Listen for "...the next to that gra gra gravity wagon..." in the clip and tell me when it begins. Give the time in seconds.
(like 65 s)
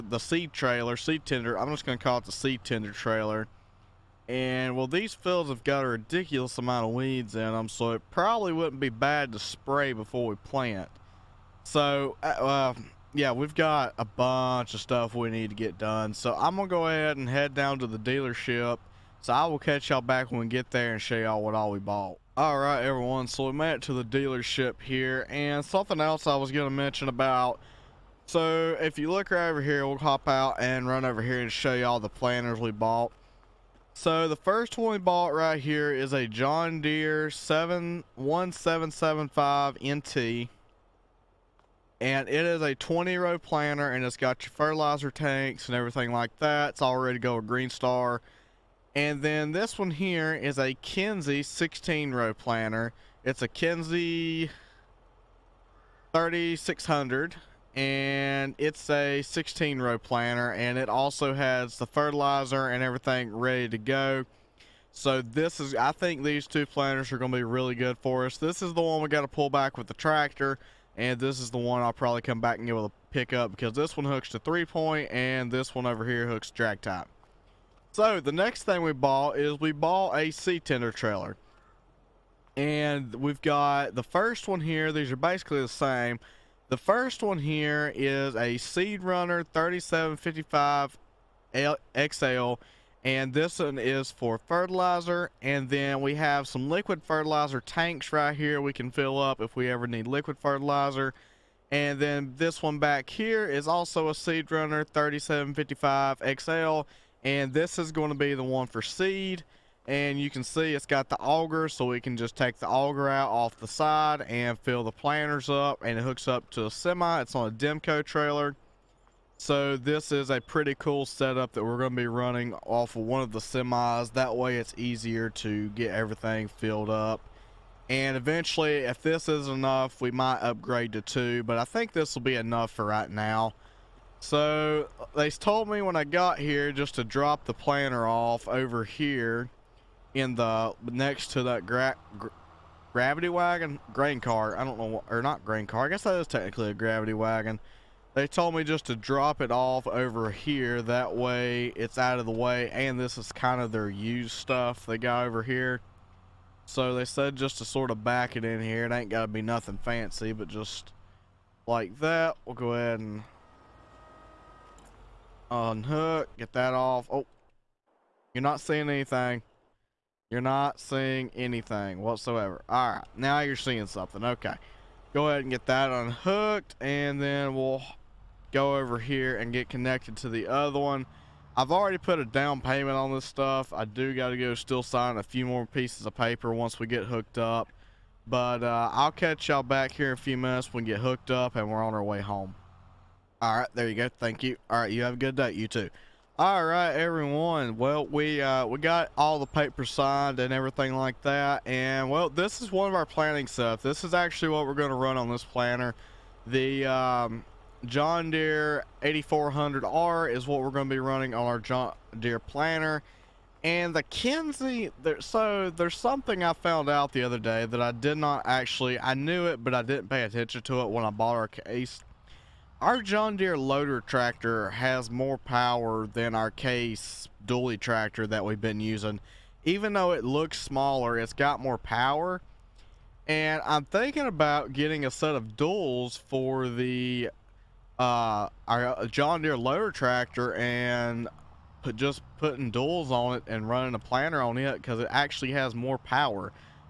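140 s.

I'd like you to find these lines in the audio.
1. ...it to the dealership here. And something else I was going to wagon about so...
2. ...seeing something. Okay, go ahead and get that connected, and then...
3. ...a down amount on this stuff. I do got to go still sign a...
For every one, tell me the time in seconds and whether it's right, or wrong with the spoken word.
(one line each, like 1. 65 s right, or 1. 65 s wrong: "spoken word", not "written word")
1. 23 s wrong: "mention", not "wagon"
2. 173 s wrong: "unhooked", not "connected"
3. 182 s wrong: "payment", not "amount".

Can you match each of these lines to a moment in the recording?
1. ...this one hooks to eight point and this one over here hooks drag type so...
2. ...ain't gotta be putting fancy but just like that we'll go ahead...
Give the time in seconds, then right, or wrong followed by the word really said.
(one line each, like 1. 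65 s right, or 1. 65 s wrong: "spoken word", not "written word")
1. 73 s wrong: "three", not "eight"
2. 158 s wrong: "nothing", not "putting".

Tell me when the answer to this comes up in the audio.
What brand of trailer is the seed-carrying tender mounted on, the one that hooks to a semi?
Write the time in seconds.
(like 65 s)
117 s.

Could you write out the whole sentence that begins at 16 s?
So I'm going to go ahead and head down to the dealership.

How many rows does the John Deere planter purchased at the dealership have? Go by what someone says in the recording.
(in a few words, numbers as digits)
20.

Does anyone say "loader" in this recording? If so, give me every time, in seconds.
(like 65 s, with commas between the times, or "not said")
223 s, 239 s.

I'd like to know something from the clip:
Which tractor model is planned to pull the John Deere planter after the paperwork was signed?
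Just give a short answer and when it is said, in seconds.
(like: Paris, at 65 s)
John Deere 8400R, at 207 s.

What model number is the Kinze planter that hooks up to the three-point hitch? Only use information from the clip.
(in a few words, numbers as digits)
3600.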